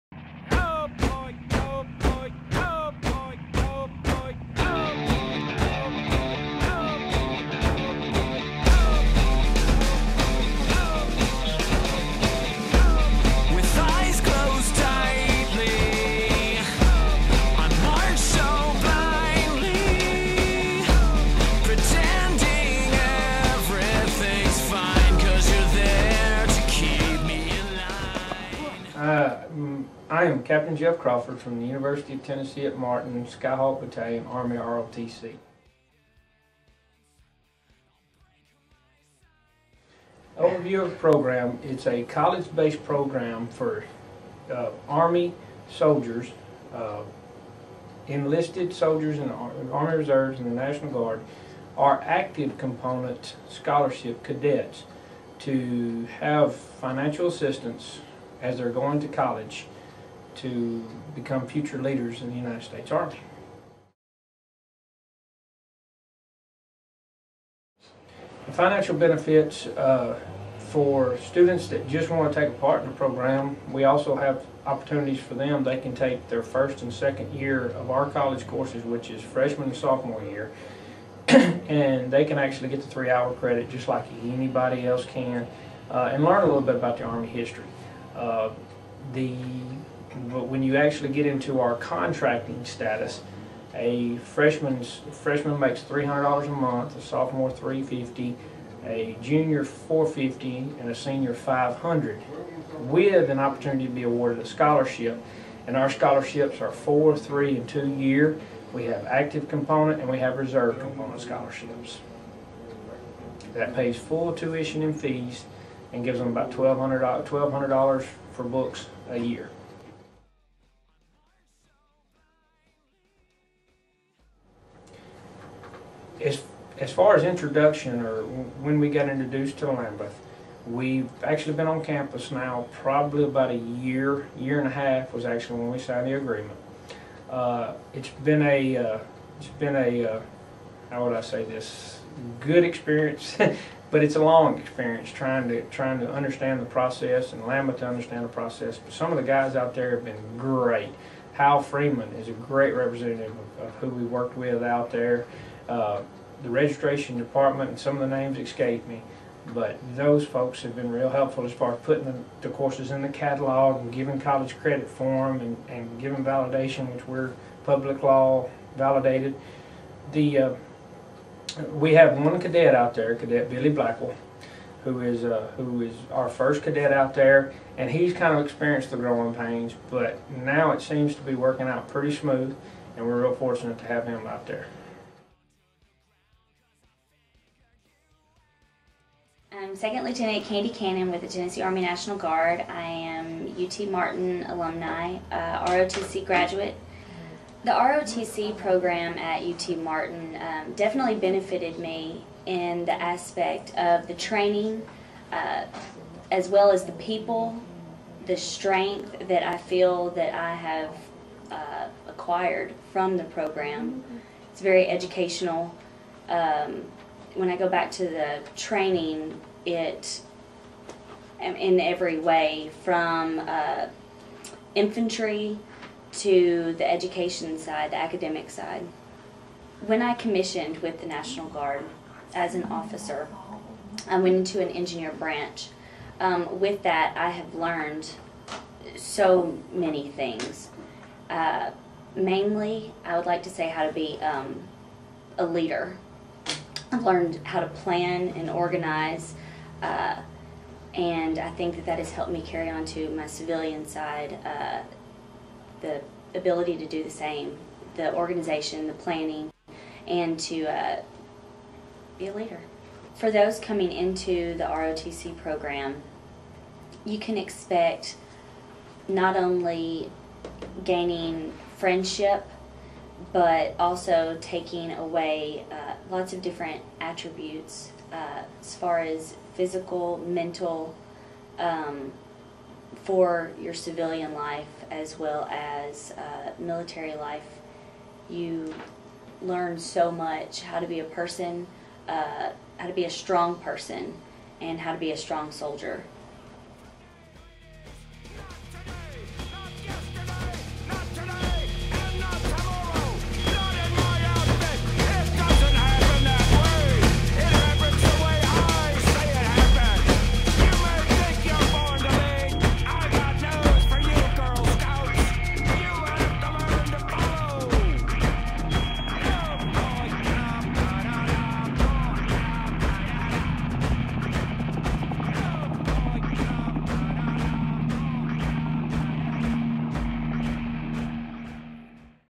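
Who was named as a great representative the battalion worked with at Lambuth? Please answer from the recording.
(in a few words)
Hal Freeman.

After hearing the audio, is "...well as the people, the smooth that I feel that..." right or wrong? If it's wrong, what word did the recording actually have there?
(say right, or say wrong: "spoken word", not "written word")
wrong: "strength", not "smooth".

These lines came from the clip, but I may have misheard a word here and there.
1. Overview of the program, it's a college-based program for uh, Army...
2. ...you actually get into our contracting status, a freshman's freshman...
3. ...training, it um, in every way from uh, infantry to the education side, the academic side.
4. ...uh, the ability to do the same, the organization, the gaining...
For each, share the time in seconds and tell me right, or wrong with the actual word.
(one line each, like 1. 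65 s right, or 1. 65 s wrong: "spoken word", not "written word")
1. 40 s right
2. 90 s right
3. 218 s right
4. 254 s wrong: "planning", not "gaining".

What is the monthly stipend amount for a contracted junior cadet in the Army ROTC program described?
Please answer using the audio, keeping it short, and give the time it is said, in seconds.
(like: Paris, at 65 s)
$450, at 99 s.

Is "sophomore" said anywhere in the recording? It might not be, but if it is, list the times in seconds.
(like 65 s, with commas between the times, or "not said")
79 s, 97 s.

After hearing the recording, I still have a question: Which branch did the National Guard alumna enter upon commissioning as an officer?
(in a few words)
Engineer.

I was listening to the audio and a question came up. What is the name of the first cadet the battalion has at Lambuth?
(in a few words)
Billy Blackwell.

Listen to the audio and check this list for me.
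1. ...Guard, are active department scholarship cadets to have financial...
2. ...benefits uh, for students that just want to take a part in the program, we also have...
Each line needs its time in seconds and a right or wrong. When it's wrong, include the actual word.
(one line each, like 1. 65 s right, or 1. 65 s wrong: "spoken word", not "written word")
1. 50 s wrong: "component", not "department"
2. 68 s right.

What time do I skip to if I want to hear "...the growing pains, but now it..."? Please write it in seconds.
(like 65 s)
178 s.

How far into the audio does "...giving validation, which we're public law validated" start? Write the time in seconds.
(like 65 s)
165 s.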